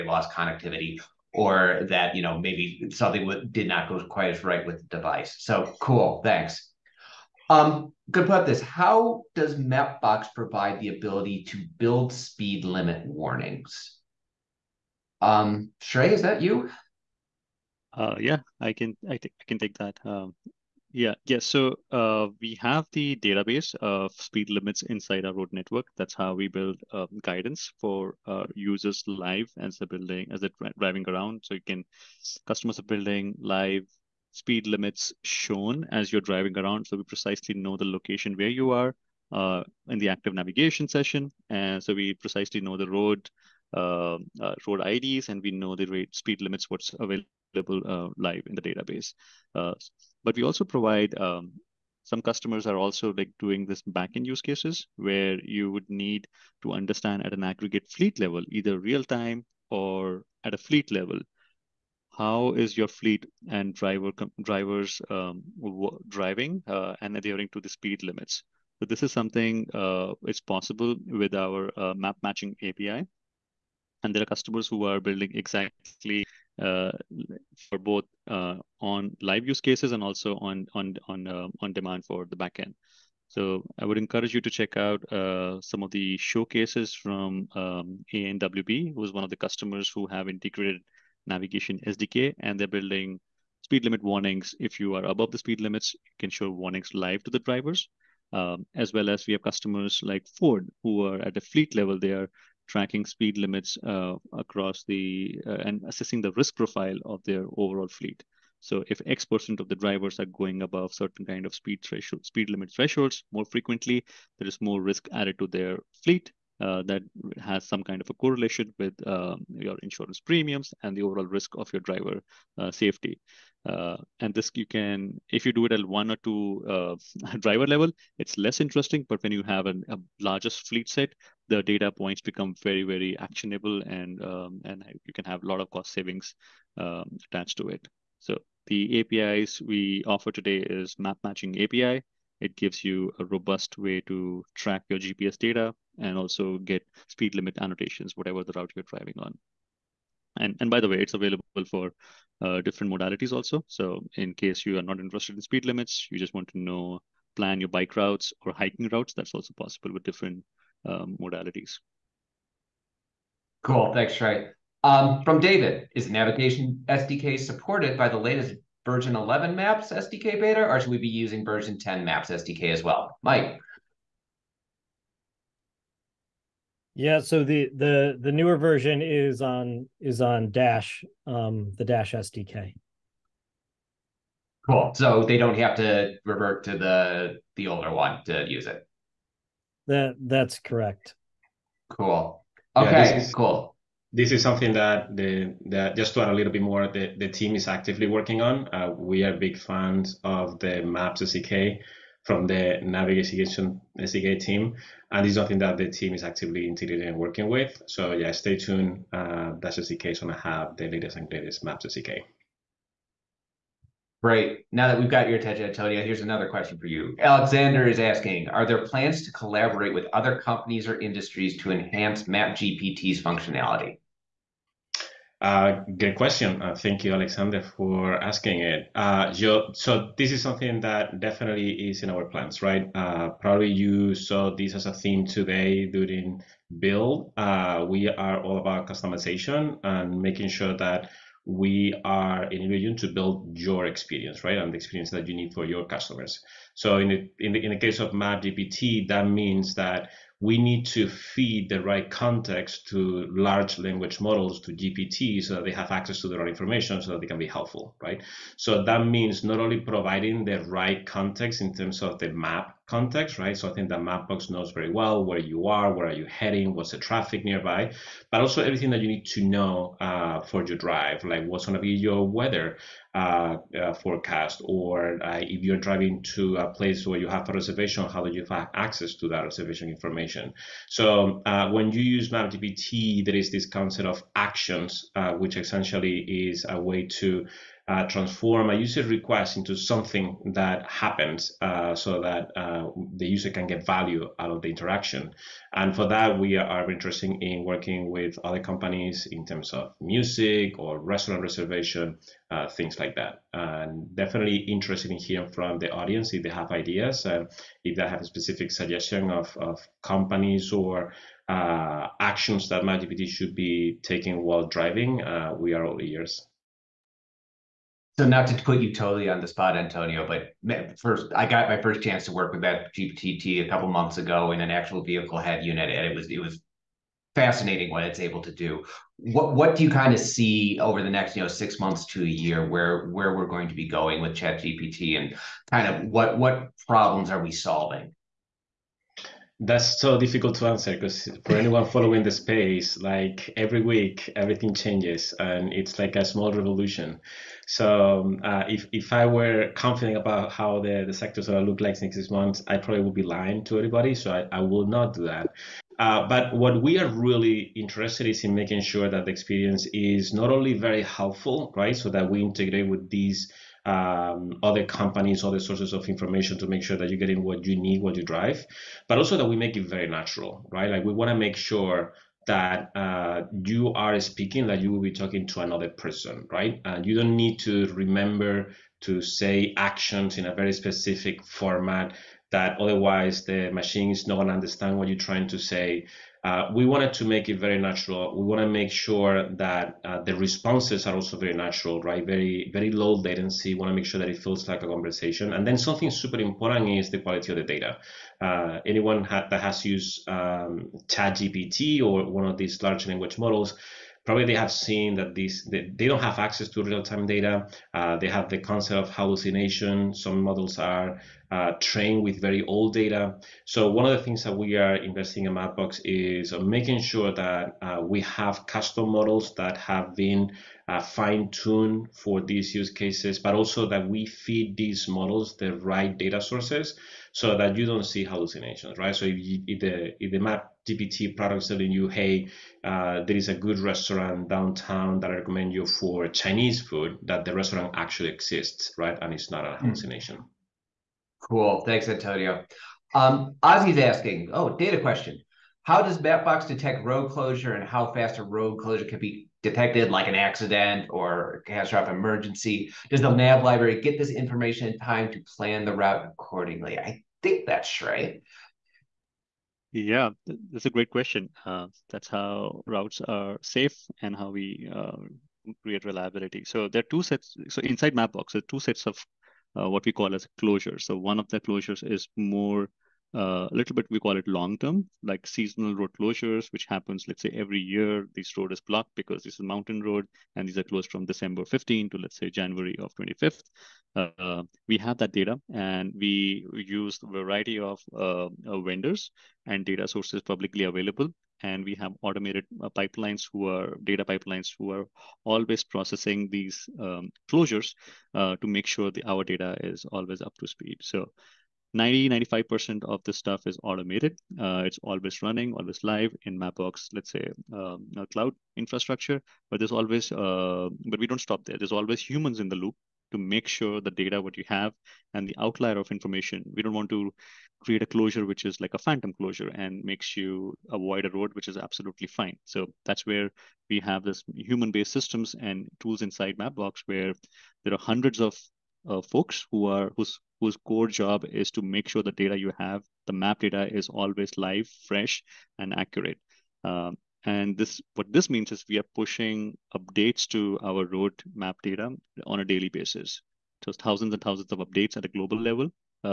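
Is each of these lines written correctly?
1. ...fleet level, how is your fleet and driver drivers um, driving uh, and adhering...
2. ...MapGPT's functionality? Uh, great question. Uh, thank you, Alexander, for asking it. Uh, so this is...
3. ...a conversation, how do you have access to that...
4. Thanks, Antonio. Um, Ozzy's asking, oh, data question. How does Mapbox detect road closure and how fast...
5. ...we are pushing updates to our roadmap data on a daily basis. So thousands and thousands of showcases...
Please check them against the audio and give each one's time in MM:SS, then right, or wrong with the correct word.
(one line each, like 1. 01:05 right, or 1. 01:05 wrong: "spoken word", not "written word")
1. 01:00 right
2. 03:42 right
3. 04:37 wrong: "reservation", not "conversation"
4. 07:21 right
5. 08:58 wrong: "updates", not "showcases".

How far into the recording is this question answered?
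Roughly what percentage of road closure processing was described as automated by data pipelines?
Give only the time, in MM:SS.
08:22.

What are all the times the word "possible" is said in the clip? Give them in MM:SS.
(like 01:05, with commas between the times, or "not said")
01:10, 02:39.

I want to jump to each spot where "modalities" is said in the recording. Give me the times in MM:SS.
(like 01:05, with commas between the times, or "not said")
02:32, 02:41.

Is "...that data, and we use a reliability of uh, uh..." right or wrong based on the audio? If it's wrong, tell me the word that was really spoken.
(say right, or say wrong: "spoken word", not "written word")
wrong: "variety", not "reliability".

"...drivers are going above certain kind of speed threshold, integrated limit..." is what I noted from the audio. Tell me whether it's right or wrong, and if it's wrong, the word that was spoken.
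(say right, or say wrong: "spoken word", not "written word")
wrong: "speed", not "integrated".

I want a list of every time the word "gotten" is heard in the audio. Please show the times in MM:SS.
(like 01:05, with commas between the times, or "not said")
not said.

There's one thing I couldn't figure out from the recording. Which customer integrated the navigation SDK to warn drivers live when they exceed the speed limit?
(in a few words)
ANWB.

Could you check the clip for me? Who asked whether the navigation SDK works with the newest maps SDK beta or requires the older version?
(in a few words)
David.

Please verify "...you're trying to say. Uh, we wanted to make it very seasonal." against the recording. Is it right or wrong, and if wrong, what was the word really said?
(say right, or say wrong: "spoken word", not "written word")
wrong: "natural", not "seasonal".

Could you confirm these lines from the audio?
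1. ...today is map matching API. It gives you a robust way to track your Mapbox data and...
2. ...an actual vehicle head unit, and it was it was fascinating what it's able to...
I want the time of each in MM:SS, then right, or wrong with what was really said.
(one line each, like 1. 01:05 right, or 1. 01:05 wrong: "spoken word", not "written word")
1. 02:20 wrong: "GPS", not "Mapbox"
2. 05:24 right.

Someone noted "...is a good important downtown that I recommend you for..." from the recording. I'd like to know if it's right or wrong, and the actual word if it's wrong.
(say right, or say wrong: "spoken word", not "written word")
wrong: "restaurant", not "important".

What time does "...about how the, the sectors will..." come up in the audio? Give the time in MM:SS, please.
05:50.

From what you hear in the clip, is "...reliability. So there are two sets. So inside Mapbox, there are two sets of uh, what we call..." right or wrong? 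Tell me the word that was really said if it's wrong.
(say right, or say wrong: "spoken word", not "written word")
right.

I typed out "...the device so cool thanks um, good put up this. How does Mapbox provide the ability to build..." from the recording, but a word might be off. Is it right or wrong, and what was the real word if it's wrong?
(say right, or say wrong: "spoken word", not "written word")
right.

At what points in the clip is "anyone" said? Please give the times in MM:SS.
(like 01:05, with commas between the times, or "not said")
05:41, 06:38.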